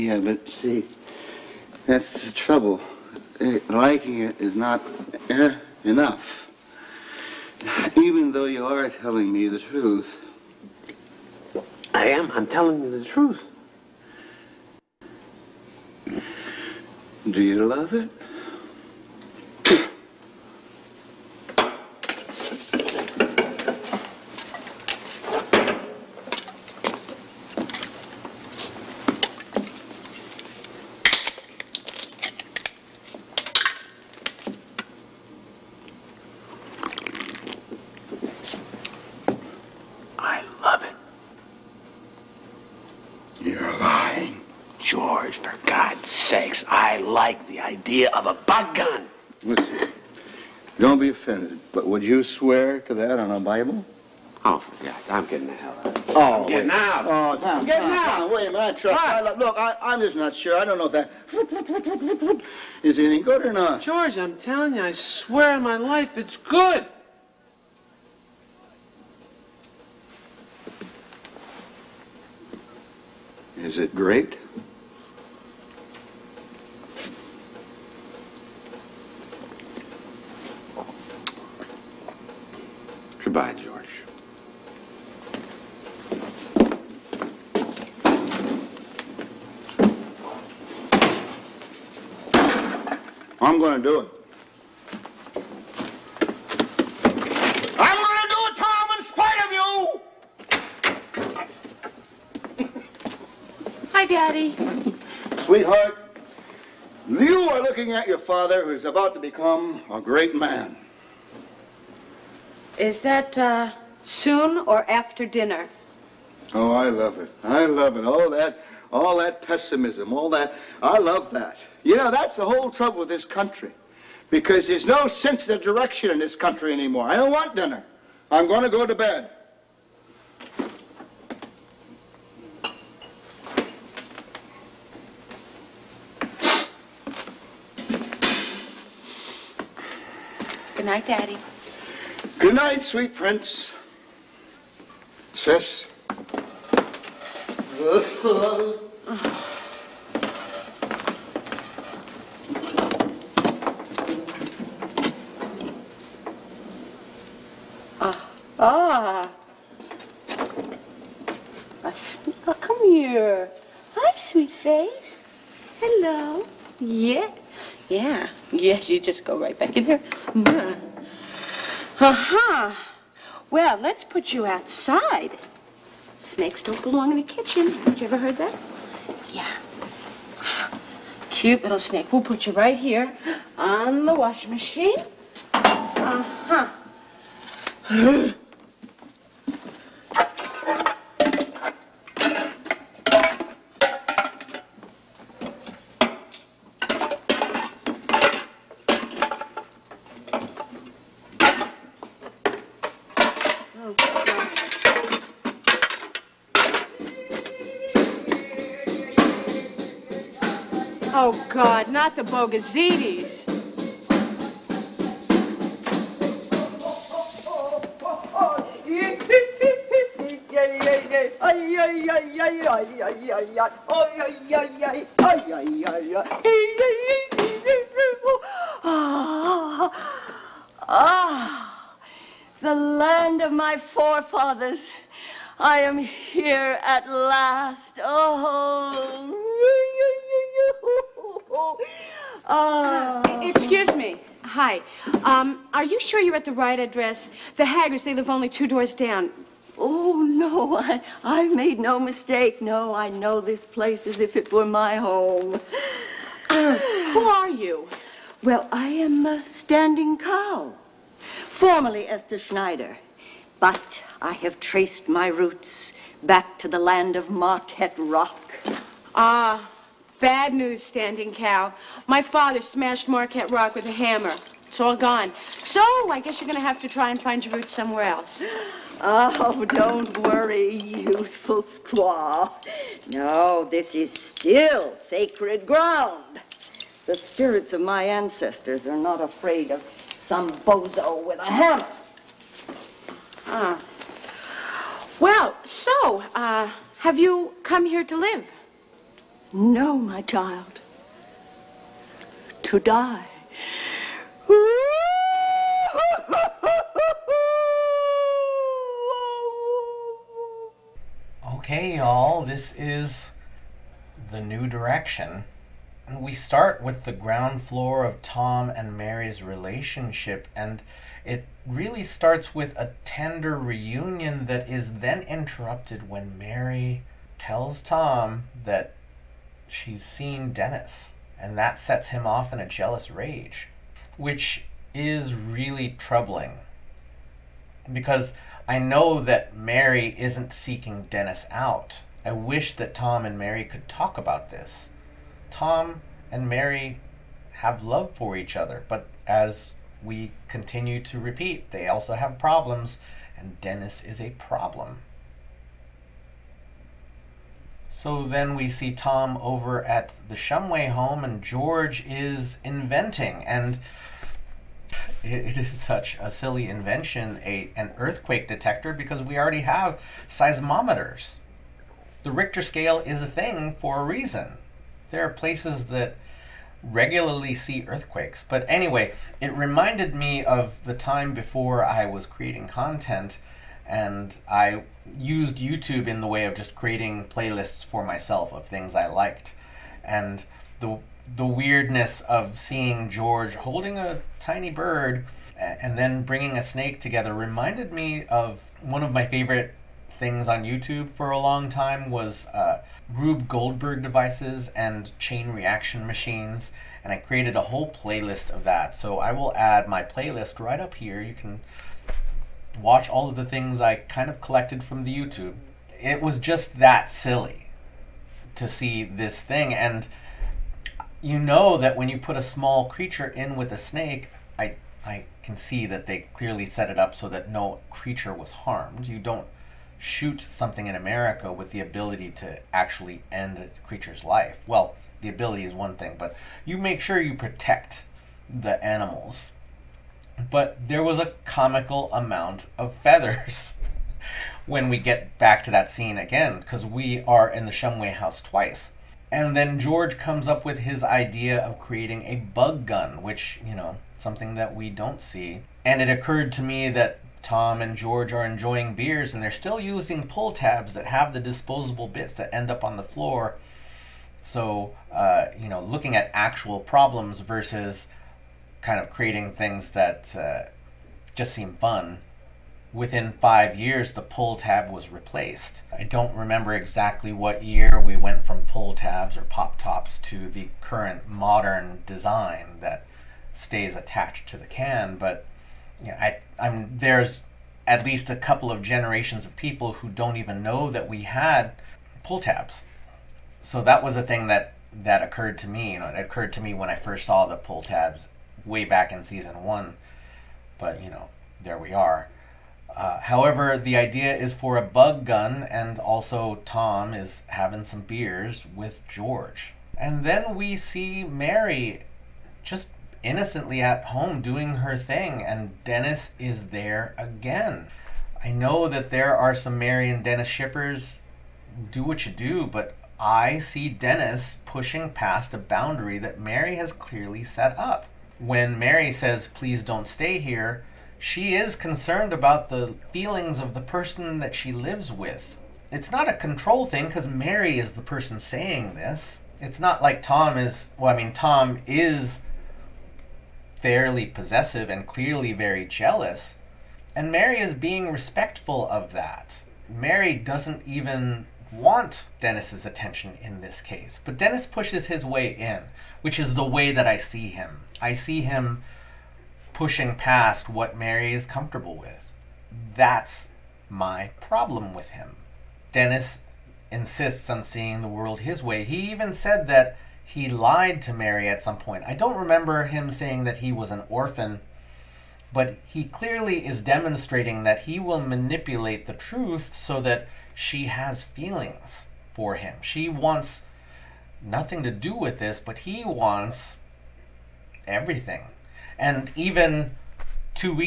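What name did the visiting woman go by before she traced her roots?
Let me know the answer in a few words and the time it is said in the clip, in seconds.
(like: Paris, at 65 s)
Esther Schneider, at 262 s.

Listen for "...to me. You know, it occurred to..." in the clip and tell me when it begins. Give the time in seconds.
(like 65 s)
495 s.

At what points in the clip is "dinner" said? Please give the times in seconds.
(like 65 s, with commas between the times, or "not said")
115 s, 127 s.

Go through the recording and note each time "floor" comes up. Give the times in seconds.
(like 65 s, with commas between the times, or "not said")
317 s, 463 s.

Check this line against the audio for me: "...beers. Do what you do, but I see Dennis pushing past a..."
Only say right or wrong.
wrong.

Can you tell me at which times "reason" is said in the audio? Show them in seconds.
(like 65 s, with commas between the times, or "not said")
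374 s.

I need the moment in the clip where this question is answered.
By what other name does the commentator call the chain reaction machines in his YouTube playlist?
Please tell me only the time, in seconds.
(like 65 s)
403 s.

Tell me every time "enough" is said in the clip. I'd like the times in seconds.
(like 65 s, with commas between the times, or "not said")
5 s.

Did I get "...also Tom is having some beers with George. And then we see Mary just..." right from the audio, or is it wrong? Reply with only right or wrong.
right.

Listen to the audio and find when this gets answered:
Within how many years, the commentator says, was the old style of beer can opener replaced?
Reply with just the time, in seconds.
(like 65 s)
473 s.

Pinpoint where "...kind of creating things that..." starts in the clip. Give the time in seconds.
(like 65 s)
468 s.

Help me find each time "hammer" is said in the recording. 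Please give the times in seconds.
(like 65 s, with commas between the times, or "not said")
273 s, 291 s.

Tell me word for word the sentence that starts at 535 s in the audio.
It's not a control thing because Mary is the person saying this.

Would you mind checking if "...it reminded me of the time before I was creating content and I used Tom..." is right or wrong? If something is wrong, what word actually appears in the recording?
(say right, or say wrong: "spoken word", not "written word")
wrong: "YouTube", not "Tom".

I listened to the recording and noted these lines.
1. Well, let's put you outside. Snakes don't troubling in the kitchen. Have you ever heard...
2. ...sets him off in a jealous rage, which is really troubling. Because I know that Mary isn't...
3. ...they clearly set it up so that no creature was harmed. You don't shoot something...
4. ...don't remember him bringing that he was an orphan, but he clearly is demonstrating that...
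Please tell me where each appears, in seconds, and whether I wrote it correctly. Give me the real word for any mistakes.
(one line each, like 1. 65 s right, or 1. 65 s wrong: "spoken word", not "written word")
1. 173 s wrong: "belong", not "troubling"
2. 331 s right
3. 426 s right
4. 572 s wrong: "saying", not "bringing".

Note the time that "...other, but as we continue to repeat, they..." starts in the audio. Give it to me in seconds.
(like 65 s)
348 s.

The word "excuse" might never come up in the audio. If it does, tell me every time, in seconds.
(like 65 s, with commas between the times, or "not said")
243 s.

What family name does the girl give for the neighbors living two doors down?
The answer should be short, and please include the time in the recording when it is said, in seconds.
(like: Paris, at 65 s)
The Haggers, at 247 s.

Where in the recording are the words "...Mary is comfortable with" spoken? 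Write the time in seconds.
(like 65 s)
560 s.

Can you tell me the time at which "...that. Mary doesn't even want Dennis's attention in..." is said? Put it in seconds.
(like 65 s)
549 s.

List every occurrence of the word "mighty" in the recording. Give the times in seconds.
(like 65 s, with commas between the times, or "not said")
not said.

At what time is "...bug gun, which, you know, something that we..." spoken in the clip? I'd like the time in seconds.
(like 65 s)
452 s.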